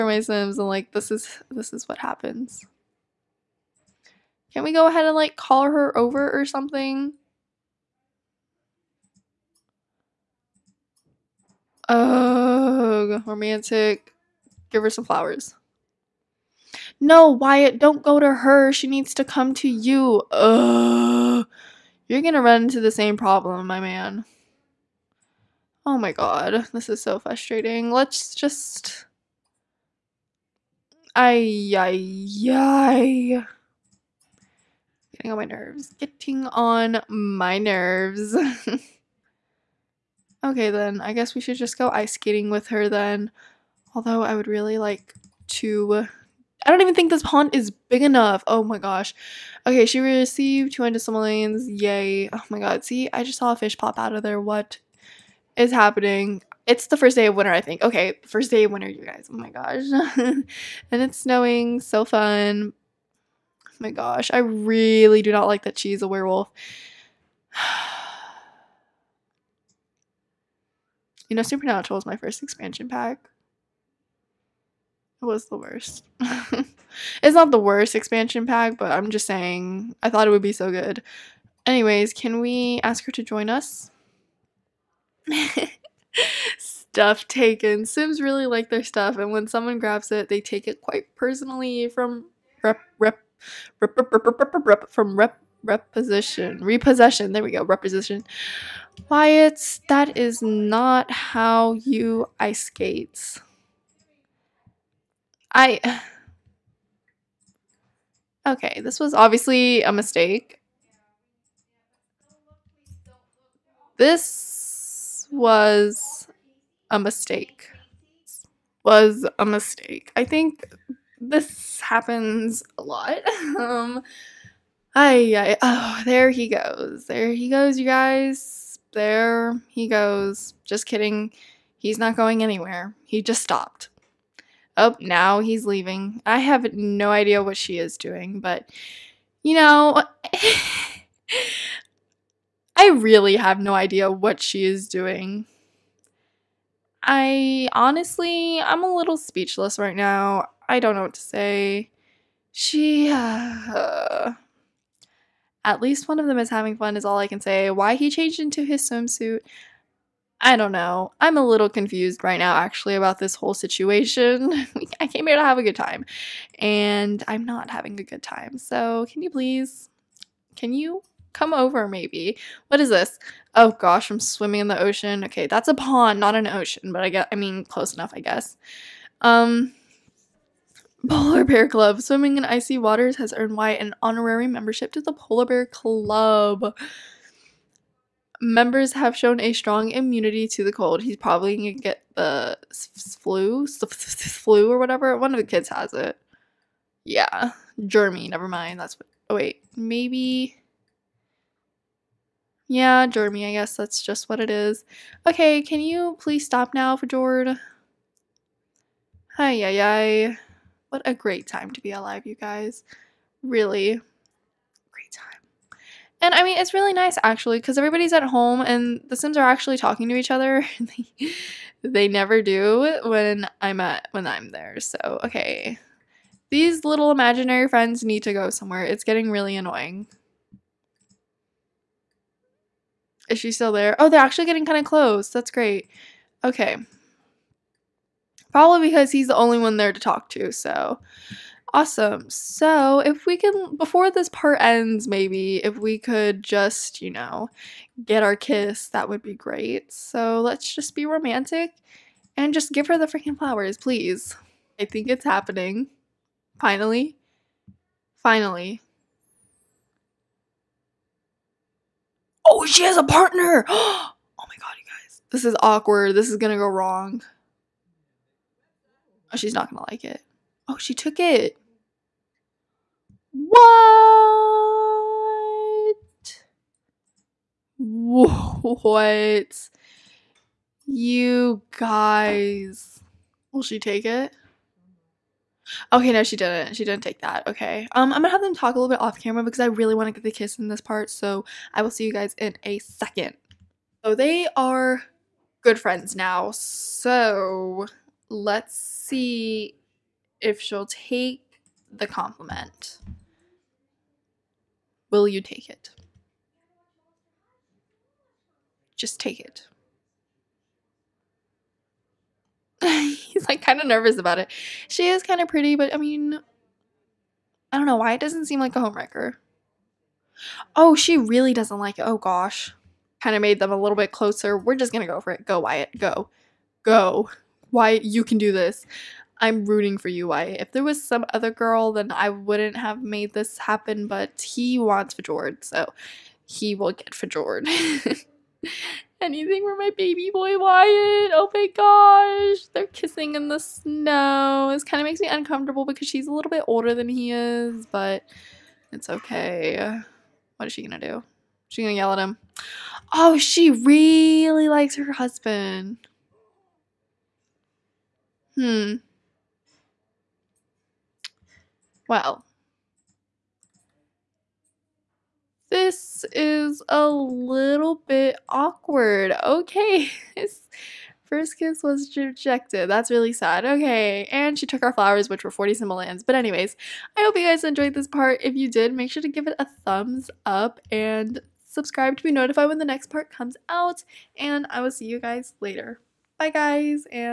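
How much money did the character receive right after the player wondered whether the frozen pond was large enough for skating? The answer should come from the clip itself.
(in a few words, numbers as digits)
200 simoleons.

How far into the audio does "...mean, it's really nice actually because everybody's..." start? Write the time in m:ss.
3:36.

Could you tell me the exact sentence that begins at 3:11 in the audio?
He's probably gonna get the flu, flu or whatever.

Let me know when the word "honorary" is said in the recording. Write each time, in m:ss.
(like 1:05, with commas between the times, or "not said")
3:04.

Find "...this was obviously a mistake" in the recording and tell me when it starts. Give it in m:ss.
1:48.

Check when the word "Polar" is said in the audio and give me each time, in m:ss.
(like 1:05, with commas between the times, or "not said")
3:01, 3:05.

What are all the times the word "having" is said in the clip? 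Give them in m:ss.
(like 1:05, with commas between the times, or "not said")
2:36, 2:47.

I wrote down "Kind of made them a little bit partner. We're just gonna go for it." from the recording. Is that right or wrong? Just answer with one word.
wrong.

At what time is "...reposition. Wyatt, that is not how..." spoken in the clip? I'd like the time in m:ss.
1:37.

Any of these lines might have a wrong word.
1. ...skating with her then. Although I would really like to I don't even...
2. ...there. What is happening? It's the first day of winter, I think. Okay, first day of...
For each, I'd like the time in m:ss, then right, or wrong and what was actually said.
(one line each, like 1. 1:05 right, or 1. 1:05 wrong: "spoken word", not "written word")
1. 0:42 right
2. 0:54 right.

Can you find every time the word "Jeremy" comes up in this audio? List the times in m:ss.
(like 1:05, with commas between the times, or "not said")
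3:17, 3:23.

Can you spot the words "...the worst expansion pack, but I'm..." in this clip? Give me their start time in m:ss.
1:17.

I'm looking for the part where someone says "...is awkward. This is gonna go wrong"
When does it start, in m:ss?
4:25.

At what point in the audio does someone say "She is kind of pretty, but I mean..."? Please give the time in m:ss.
5:14.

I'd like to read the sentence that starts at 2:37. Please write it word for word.
Why he changed into his swimsuit, I don't know.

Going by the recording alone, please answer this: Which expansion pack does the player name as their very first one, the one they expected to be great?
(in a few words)
Supernatural.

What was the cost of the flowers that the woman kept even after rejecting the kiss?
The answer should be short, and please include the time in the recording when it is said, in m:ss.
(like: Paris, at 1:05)
40 simoleons, at 6:15.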